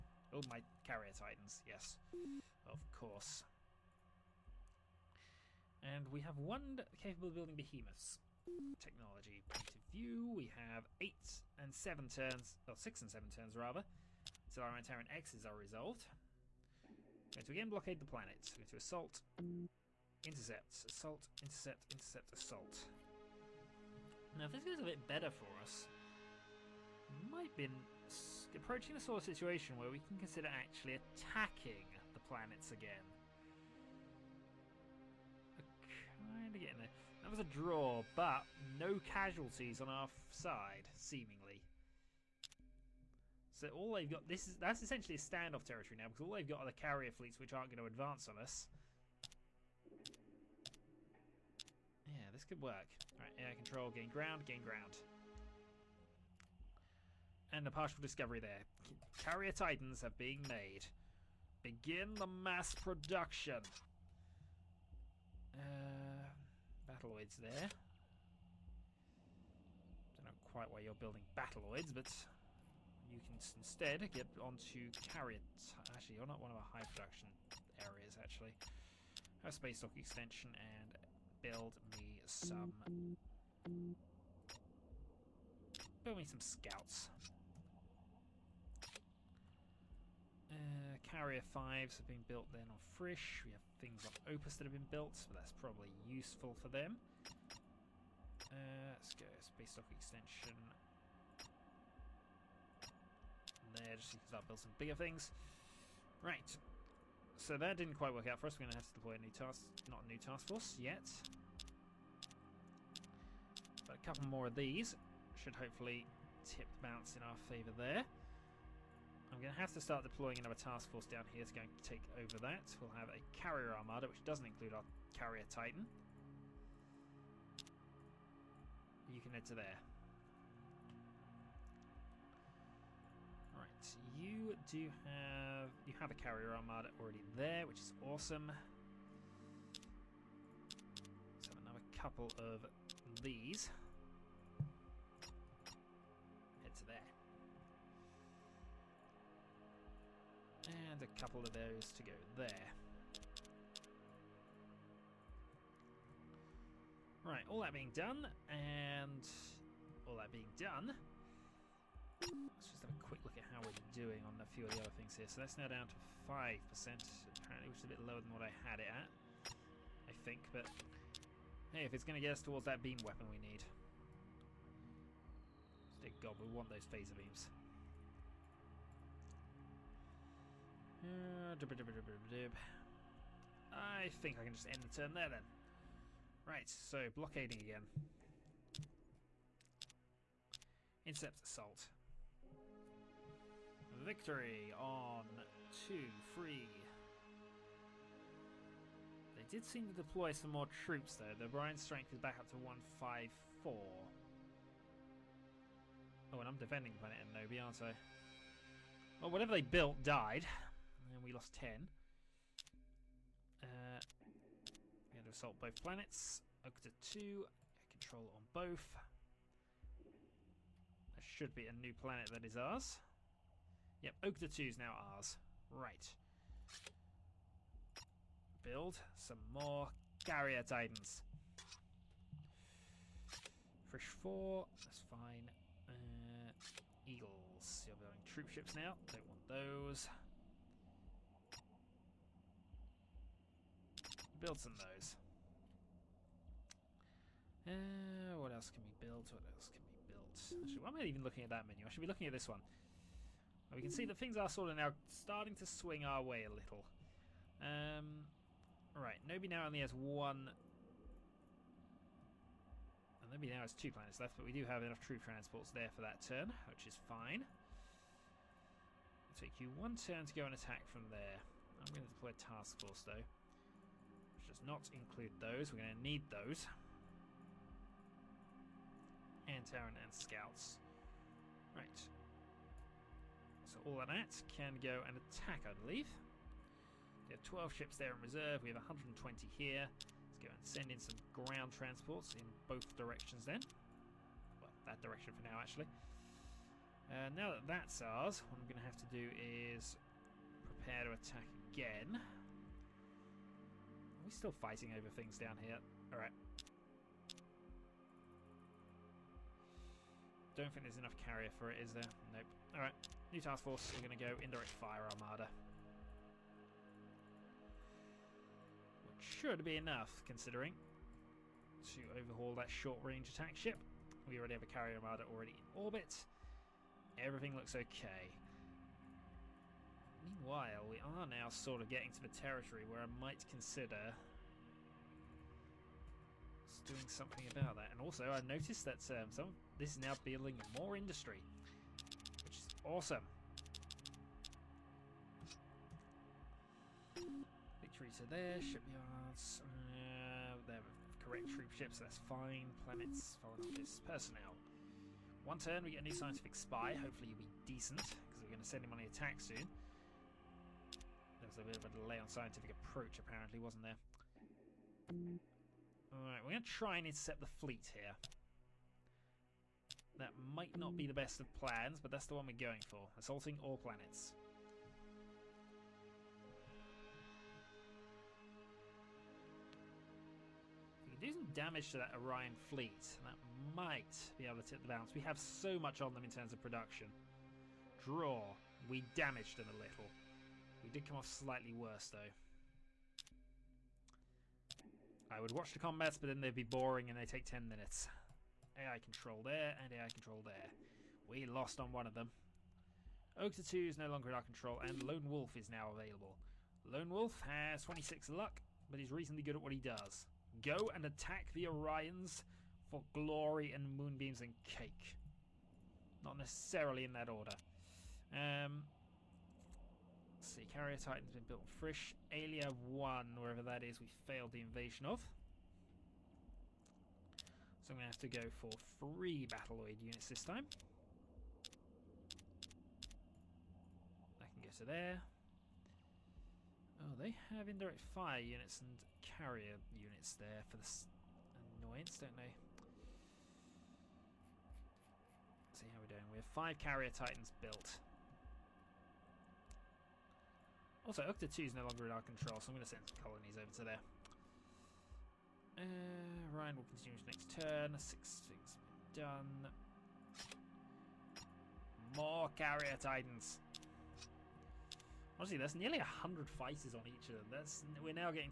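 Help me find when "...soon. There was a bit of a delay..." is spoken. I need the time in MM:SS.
05:59.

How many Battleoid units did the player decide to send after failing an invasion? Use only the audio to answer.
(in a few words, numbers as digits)
3.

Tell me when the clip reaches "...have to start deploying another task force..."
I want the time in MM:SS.
01:59.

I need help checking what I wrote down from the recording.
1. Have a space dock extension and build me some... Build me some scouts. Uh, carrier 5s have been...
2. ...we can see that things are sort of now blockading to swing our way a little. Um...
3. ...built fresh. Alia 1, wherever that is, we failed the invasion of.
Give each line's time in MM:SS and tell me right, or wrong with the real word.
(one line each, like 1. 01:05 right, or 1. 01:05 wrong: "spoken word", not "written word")
1. 01:19 right
2. 04:13 wrong: "starting", not "blockading"
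3. 07:01 right.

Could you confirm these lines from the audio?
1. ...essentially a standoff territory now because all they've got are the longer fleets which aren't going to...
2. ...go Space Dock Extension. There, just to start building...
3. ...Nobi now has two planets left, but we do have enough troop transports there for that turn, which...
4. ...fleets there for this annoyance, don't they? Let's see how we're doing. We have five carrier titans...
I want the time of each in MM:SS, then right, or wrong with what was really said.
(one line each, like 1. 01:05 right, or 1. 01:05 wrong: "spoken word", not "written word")
1. 00:44 wrong: "carrier", not "longer"
2. 01:39 right
3. 04:23 right
4. 07:19 wrong: "units", not "fleets".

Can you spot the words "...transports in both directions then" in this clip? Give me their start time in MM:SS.
04:51.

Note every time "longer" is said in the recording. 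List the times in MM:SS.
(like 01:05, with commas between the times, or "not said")
06:44, 07:31.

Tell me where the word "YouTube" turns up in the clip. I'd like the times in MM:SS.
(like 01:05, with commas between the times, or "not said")
not said.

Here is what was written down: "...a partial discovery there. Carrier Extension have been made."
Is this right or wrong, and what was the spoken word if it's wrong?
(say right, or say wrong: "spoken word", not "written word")
wrong: "Titans", not "Extension".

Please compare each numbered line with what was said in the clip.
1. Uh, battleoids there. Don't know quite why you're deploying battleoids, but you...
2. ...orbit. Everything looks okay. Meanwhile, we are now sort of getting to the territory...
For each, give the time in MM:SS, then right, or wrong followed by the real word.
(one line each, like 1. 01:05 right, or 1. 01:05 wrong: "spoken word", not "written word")
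1. 01:05 wrong: "building", not "deploying"
2. 05:25 right.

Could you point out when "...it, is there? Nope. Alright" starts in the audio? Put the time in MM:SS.
05:11.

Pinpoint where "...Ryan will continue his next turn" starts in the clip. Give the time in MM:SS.
07:36.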